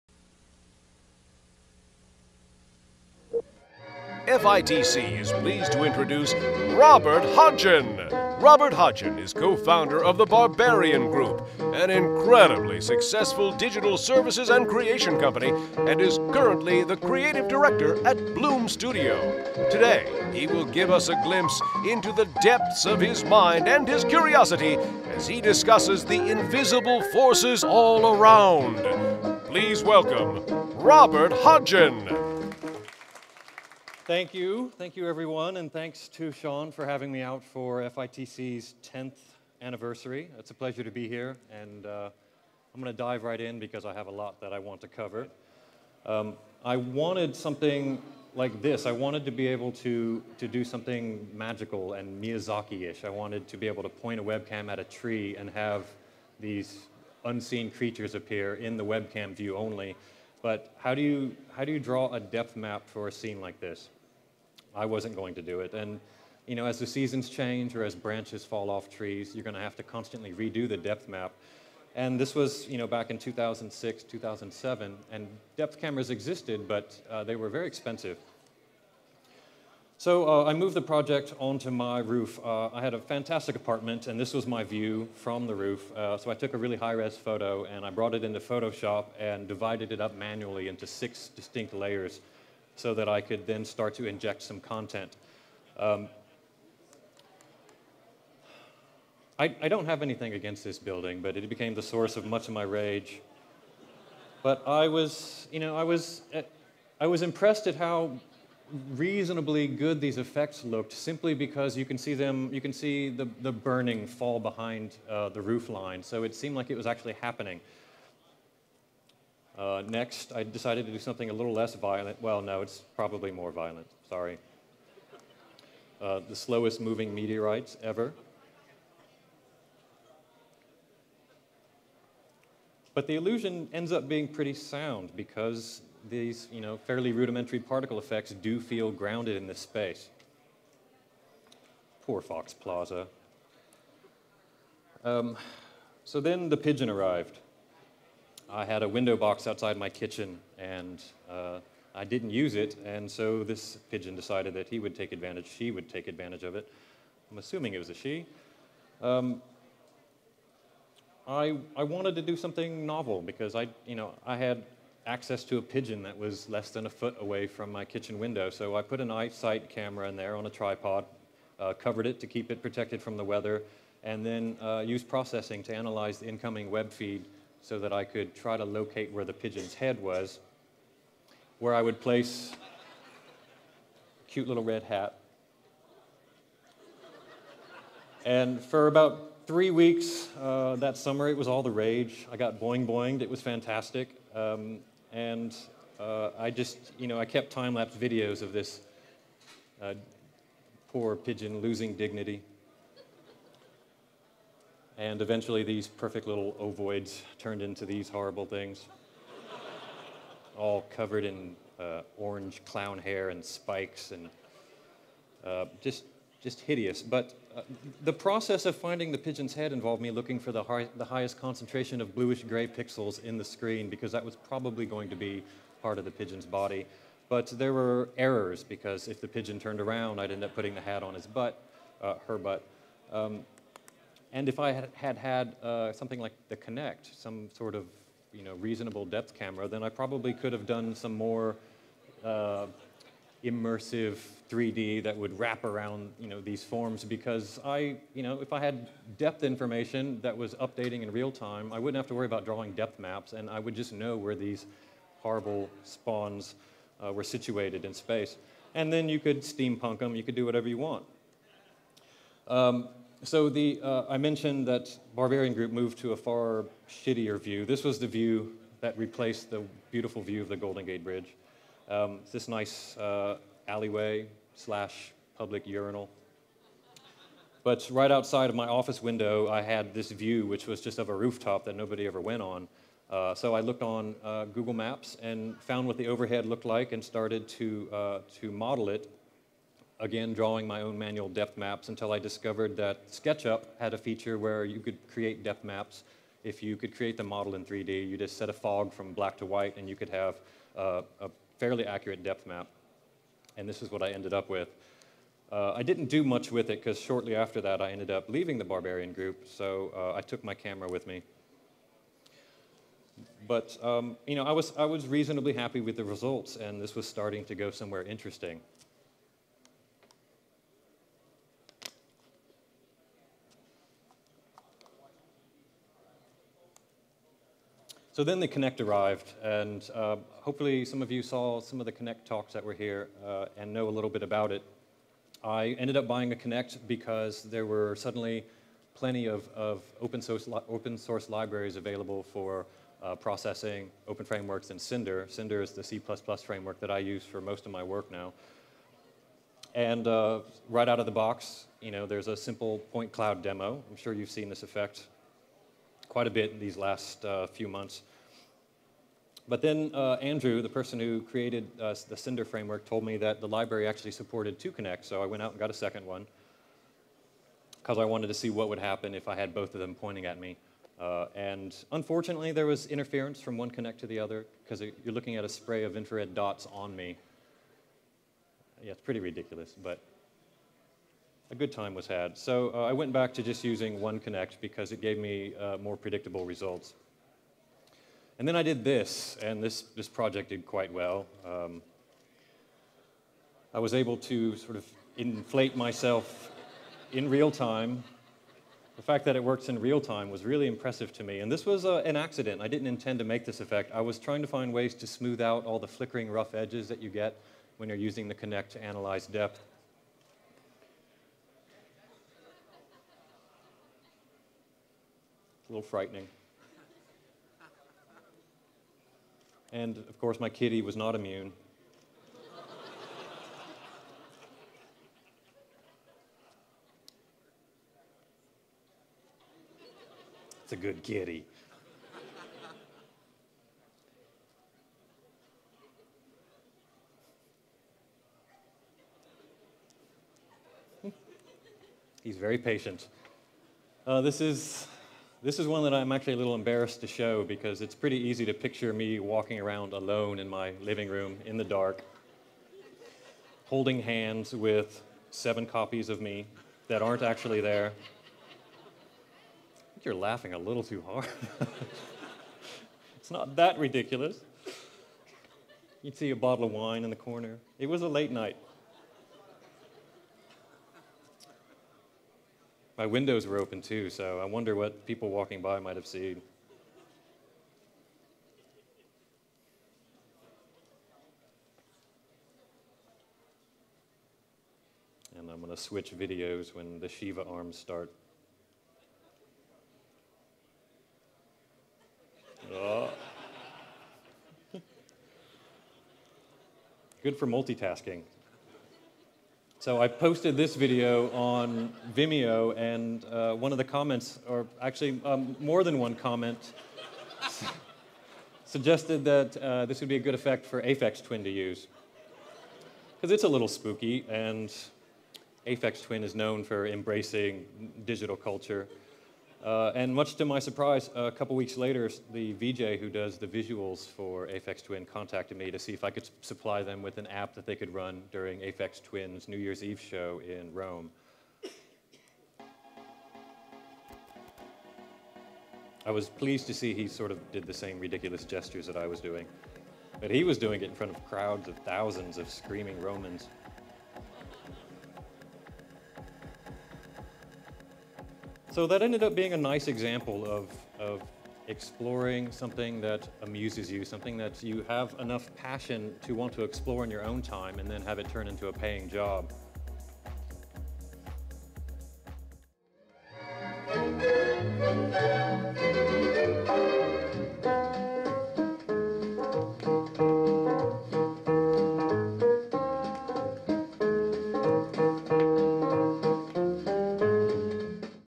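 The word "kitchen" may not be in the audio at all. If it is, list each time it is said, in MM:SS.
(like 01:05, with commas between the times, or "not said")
02:29, 02:47.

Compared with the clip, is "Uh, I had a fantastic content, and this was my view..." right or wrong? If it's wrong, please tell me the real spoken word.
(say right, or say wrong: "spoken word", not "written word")
wrong: "apartment", not "content".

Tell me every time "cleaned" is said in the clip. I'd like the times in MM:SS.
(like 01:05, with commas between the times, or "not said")
not said.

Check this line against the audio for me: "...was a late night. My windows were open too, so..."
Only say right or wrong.
right.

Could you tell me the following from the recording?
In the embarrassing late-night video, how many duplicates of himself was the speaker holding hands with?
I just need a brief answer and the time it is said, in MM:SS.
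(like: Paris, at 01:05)
7, at 07:35.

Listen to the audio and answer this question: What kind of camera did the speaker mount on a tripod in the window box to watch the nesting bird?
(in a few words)
iSight.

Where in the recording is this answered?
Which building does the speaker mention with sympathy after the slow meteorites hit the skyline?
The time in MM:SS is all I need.
02:22.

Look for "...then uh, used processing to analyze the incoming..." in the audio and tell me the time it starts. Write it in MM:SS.
02:54.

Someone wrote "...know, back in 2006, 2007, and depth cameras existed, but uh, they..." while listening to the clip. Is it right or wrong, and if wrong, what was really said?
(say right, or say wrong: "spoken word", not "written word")
right.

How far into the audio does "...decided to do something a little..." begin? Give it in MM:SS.
02:00.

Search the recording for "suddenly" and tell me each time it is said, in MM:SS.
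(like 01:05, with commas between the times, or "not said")
05:37.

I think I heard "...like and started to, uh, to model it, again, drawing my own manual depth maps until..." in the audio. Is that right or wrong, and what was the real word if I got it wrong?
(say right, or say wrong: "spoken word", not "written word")
right.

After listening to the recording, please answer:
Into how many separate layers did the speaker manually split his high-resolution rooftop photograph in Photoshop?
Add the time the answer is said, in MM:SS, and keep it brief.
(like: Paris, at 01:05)
6, at 01:30.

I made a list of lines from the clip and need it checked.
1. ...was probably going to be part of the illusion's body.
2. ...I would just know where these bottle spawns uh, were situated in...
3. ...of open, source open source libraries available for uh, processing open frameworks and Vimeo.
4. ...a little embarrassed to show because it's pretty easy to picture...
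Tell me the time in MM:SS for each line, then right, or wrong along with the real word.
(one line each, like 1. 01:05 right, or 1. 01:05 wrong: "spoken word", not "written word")
1. 03:44 wrong: "pigeon", not "illusion"
2. 04:13 wrong: "horrible", not "bottle"
3. 05:39 wrong: "Cinder", not "Vimeo"
4. 07:26 right.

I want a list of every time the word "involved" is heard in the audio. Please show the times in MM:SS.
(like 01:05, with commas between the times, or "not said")
03:39.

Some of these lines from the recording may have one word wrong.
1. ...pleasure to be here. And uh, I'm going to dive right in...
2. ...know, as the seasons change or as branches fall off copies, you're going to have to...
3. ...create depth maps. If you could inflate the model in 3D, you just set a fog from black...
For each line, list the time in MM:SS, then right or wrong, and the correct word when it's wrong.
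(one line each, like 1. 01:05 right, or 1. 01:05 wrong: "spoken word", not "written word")
1. 00:40 right
2. 01:06 wrong: "trees", not "copies"
3. 04:55 wrong: "create", not "inflate".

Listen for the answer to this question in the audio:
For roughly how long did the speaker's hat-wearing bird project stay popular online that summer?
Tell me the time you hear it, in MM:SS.
03:08.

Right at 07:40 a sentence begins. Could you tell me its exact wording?
You're laughing a little too hard.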